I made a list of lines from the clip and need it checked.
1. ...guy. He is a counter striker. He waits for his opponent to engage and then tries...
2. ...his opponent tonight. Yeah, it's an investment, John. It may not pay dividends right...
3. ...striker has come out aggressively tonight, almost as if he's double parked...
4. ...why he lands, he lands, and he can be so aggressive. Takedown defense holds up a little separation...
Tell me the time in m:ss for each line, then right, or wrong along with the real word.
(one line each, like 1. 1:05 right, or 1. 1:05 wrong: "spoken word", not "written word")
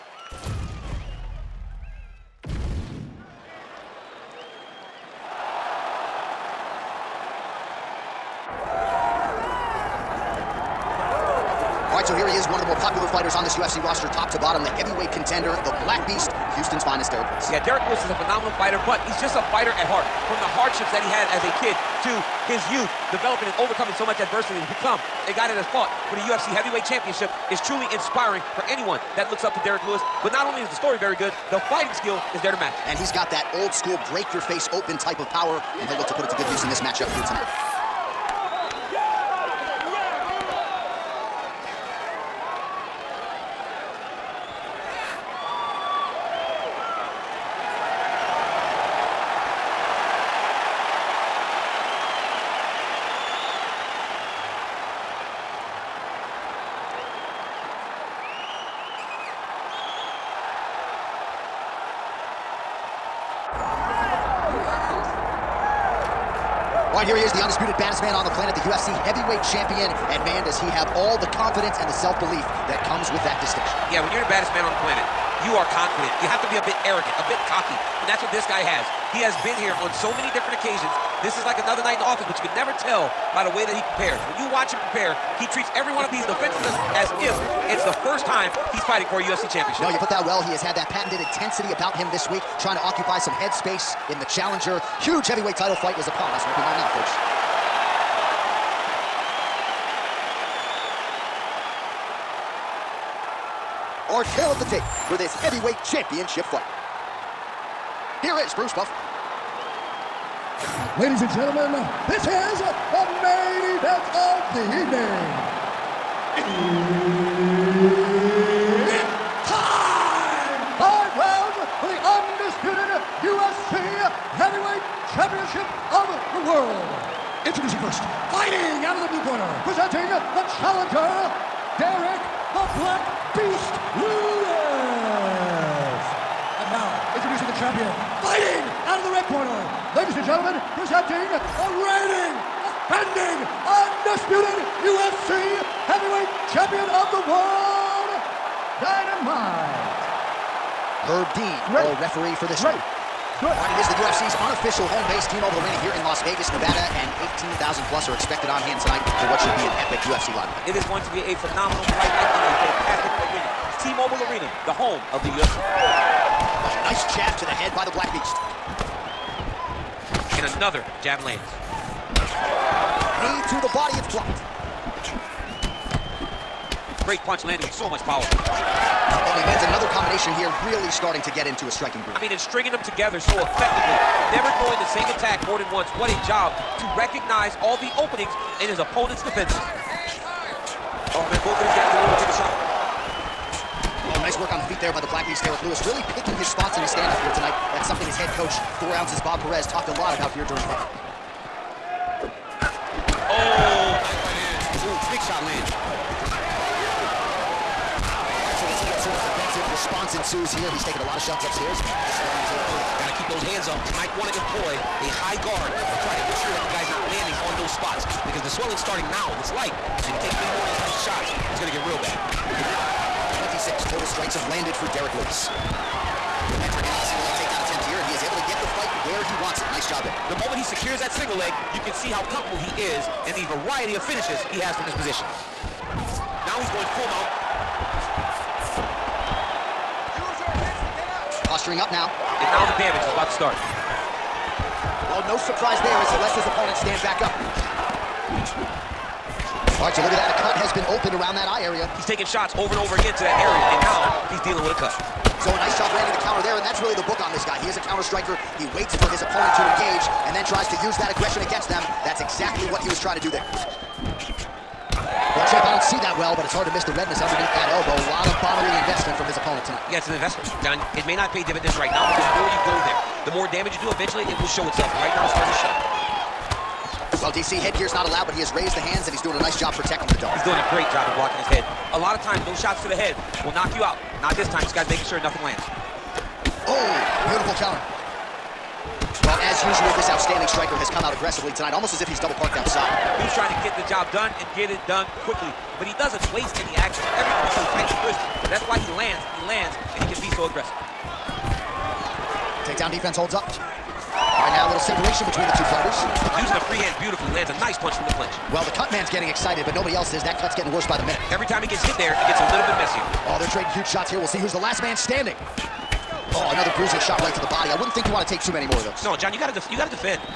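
1. 4:17 right
2. 4:29 right
3. 4:50 right
4. 4:58 right.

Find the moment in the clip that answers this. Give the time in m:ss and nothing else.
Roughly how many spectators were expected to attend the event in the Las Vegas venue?
2:37.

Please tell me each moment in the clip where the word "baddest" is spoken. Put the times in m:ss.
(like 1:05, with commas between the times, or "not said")
1:07, 1:14.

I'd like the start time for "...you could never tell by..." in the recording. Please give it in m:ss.
1:22.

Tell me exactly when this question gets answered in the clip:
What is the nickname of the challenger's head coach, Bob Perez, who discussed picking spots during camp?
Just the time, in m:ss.
3:18.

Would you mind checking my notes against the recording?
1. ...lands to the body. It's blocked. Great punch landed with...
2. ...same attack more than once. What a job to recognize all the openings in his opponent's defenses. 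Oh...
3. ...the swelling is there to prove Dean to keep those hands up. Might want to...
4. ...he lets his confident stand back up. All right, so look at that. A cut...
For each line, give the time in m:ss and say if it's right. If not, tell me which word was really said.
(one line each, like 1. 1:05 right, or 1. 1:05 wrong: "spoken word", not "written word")
1. 2:51 right
2. 3:04 right
3. 3:31 wrong: "Got", not "Dean"
4. 4:06 wrong: "opponent", not "confident".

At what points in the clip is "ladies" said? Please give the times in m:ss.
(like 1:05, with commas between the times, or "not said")
1:50, 2:19.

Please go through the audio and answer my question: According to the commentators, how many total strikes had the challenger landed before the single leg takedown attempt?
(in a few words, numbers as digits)
26.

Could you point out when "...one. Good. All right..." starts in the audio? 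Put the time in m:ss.
2:32.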